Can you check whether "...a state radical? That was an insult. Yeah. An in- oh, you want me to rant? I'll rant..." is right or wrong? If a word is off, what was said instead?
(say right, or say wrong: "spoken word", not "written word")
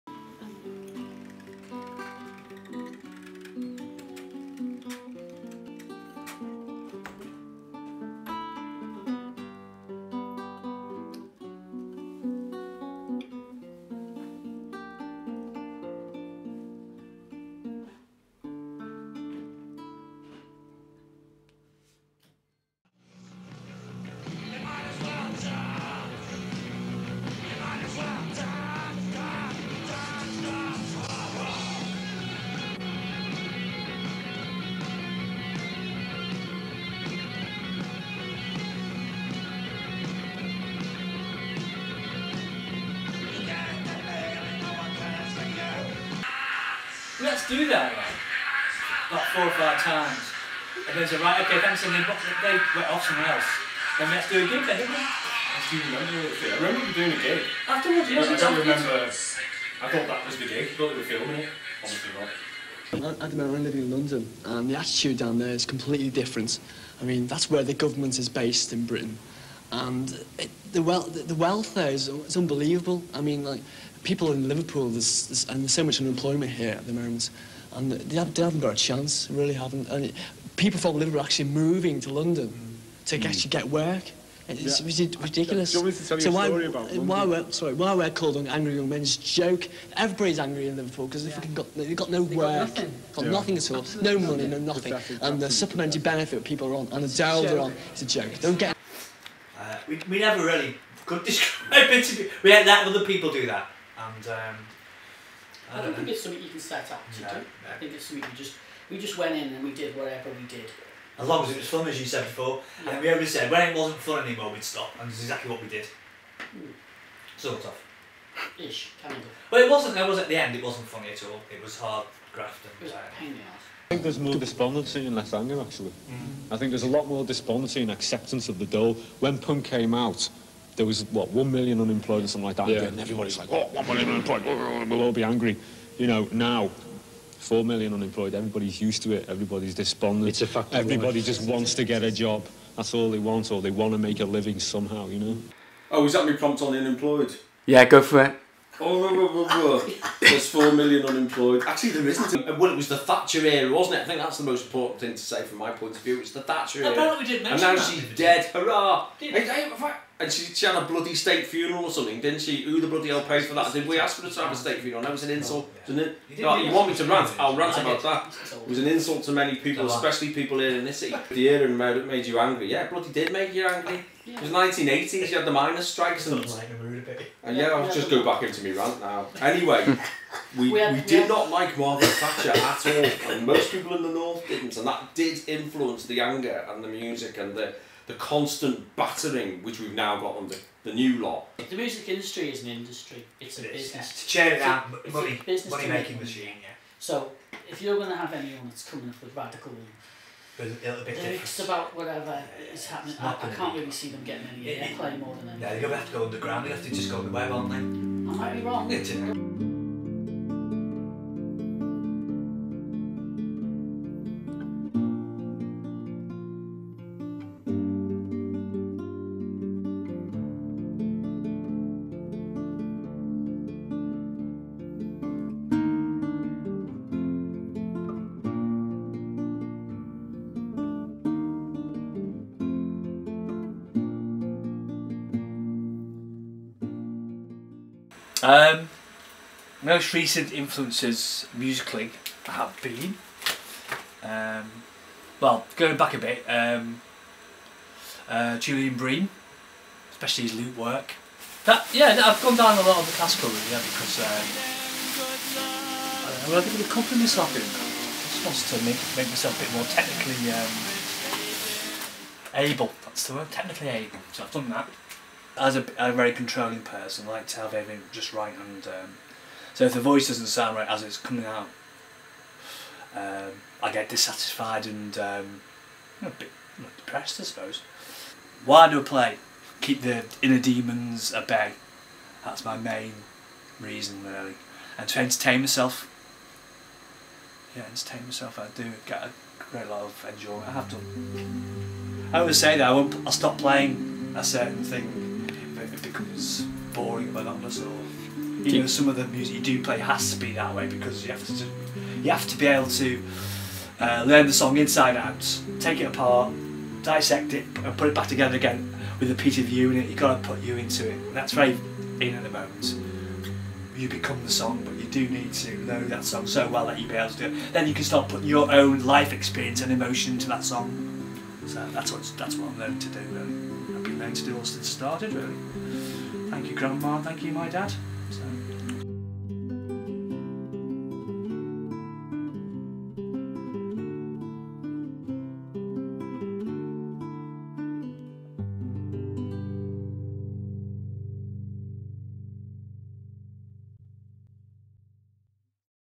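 wrong: "funeral", not "radical".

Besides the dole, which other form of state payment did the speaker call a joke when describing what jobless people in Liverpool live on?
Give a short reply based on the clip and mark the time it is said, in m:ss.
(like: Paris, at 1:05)
supplementary benefit, at 1:35.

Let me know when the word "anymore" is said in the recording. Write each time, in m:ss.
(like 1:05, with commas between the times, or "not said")
1:54.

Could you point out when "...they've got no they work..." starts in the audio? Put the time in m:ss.
1:31.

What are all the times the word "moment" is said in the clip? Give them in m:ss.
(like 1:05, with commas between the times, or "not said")
1:03, 1:16, 5:12.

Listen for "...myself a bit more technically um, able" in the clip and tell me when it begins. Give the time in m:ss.
4:19.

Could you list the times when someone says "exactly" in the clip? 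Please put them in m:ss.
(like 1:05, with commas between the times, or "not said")
1:34, 1:55.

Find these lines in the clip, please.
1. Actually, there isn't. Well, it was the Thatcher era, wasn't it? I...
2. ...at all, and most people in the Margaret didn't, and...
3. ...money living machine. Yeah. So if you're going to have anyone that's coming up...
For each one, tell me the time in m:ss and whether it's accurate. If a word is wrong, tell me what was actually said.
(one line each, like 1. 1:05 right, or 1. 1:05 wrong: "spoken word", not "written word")
1. 2:31 right
2. 3:02 wrong: "North", not "Margaret"
3. 3:15 wrong: "making", not "living".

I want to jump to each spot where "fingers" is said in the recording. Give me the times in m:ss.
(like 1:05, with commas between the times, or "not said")
not said.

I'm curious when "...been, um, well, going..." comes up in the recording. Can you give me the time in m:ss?
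4:02.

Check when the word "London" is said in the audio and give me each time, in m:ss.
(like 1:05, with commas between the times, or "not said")
1:03, 1:22.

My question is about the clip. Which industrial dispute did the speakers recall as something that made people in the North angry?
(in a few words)
miners' strikes.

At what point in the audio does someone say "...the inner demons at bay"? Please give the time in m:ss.
4:40.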